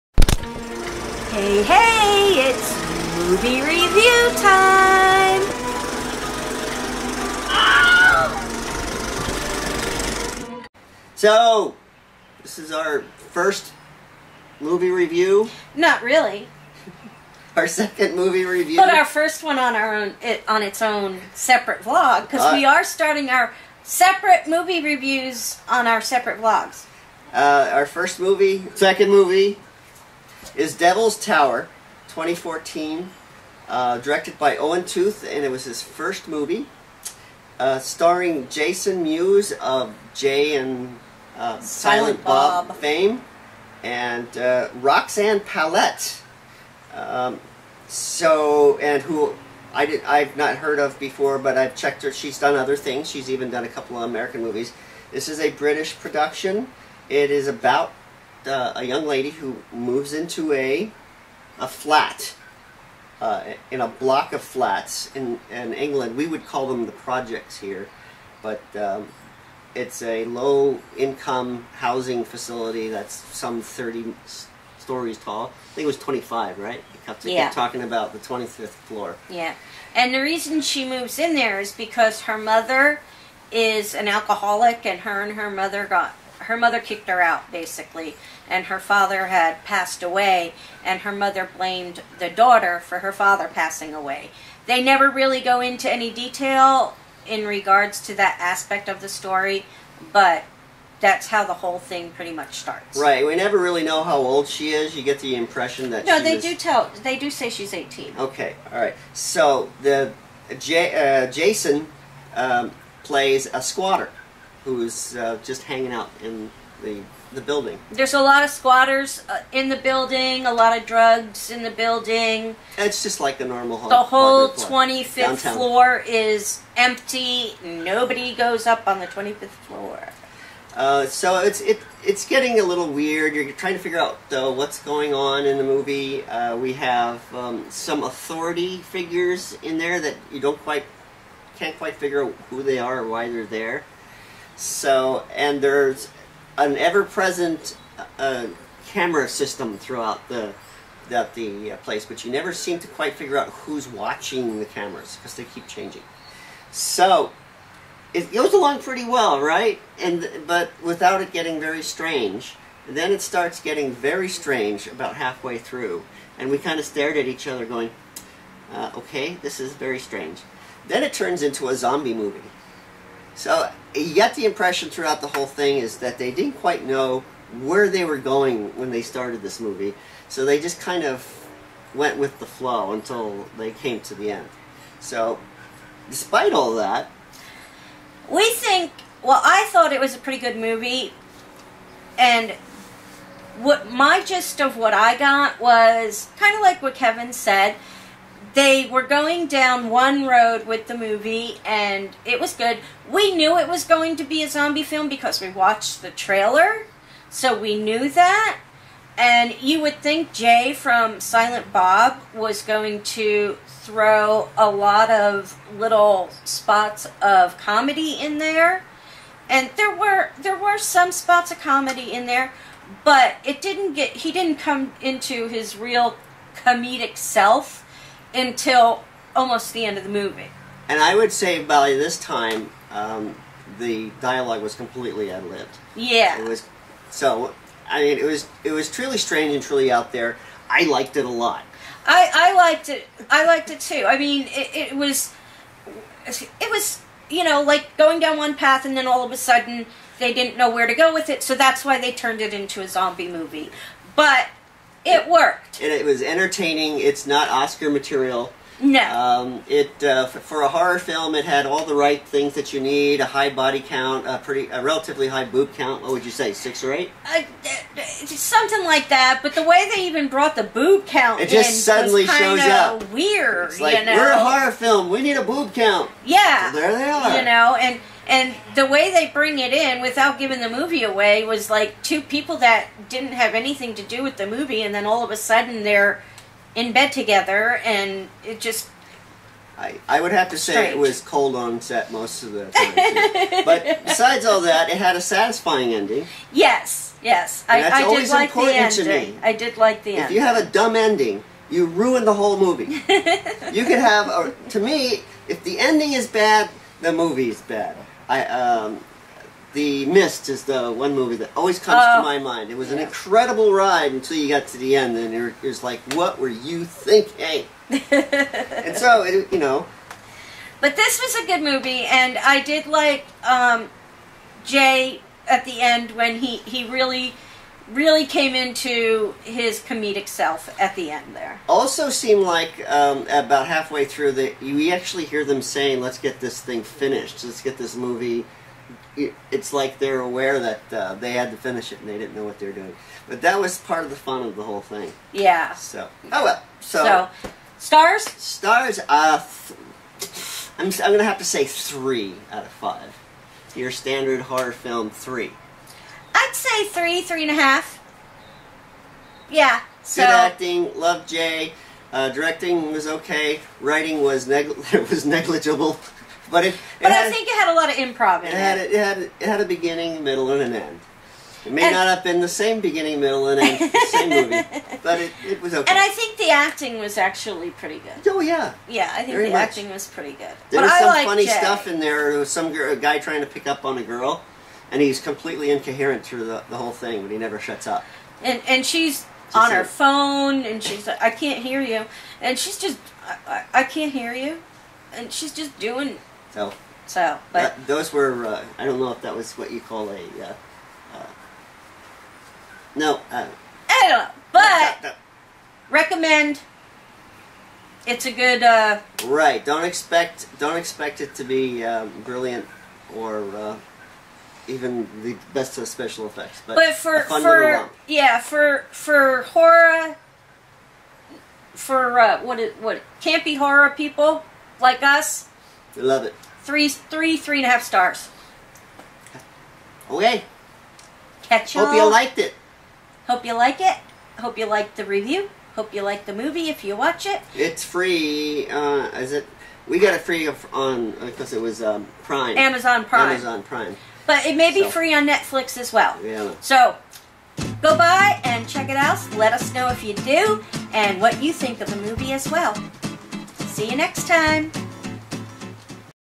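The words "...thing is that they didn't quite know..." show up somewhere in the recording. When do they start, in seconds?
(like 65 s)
175 s.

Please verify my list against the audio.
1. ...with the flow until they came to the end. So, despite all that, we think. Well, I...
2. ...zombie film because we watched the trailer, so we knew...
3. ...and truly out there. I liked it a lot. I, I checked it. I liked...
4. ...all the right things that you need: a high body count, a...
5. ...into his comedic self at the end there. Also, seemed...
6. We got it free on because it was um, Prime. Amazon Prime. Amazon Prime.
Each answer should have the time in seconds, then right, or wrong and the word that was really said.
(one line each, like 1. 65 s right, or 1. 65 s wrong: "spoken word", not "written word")
1. 182 s right
2. 204 s right
3. 239 s wrong: "liked", not "checked"
4. 261 s right
5. 328 s right
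6. 439 s right.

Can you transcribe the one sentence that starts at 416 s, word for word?
But, but for for yeah for for horror for uh, what it what campy horror people like us.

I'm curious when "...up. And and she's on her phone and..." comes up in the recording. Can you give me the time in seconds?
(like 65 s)
387 s.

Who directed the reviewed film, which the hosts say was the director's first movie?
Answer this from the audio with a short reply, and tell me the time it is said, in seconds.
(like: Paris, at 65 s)
Owen Tooth, at 34 s.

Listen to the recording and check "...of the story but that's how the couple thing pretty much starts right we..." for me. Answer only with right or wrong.
wrong.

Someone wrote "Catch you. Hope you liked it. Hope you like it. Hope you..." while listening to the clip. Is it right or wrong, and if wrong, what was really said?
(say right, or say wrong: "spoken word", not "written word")
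right.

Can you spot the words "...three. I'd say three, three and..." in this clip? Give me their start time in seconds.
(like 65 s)
355 s.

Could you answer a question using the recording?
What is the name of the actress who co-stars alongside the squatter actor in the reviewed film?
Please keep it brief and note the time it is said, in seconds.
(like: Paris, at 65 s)
Roxanne Pallett, at 44 s.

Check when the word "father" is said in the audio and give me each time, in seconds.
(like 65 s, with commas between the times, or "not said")
88 s, 93 s.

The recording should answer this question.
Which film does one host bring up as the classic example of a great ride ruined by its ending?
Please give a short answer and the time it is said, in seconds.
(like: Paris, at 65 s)
The Mist, at 309 s.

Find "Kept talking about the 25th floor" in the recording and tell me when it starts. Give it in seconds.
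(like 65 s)
77 s.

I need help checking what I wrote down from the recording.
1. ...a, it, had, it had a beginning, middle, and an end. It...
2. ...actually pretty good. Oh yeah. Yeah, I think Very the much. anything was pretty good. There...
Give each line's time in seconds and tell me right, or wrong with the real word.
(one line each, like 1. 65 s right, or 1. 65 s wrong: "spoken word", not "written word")
1. 368 s right
2. 377 s wrong: "acting", not "anything".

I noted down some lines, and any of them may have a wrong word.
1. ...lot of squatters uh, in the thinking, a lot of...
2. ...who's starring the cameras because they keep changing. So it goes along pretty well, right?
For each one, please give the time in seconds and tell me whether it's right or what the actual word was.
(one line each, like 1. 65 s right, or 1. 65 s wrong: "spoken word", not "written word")
1. 118 s wrong: "building", not "thinking"
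2. 153 s wrong: "watching", not "starring".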